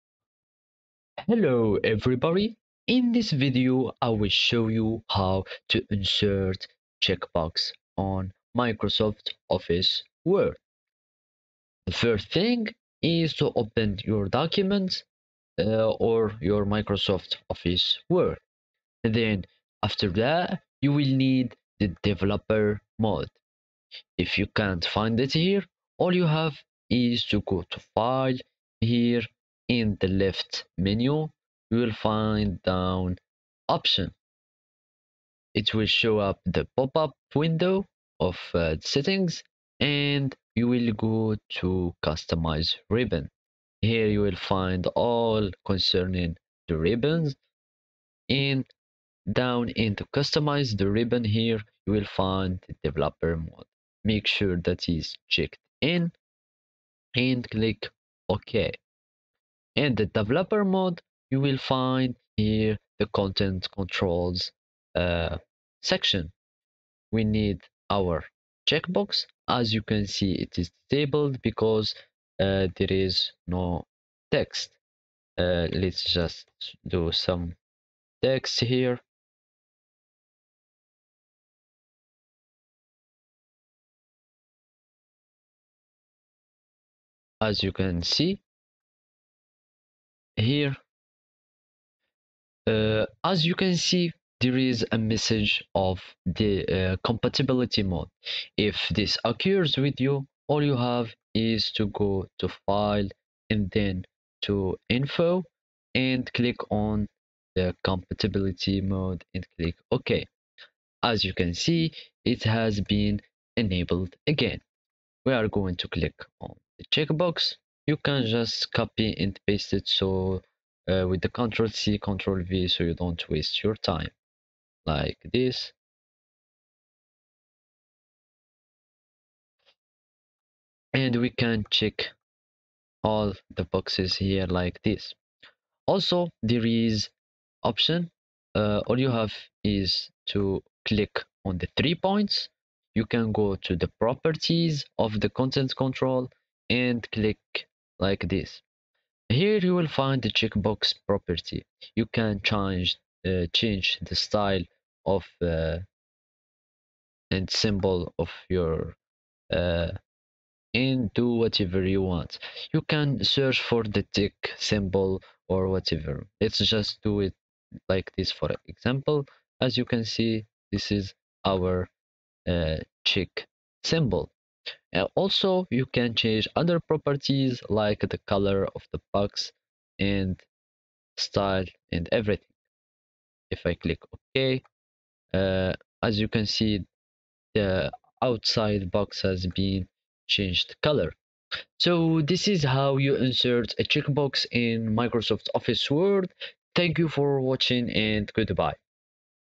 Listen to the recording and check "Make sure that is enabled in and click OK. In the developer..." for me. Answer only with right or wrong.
wrong.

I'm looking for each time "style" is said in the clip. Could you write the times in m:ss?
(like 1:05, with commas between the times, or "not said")
2:34, 3:01.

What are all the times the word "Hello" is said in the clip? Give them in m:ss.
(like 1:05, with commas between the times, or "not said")
0:01.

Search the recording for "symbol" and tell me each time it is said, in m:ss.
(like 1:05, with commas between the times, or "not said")
2:37, 2:44, 2:53.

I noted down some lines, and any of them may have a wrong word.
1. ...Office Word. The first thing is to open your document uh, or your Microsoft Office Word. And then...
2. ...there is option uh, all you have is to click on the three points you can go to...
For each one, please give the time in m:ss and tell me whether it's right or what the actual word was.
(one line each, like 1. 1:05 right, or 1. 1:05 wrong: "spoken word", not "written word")
1. 0:09 right
2. 2:16 right.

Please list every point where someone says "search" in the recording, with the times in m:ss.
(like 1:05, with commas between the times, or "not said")
2:43.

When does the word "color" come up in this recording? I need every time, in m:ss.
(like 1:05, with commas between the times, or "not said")
2:58, 3:10.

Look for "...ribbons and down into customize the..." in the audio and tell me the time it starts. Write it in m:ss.
0:46.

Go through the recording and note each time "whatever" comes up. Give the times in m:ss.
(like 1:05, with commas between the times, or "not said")
2:41, 2:45.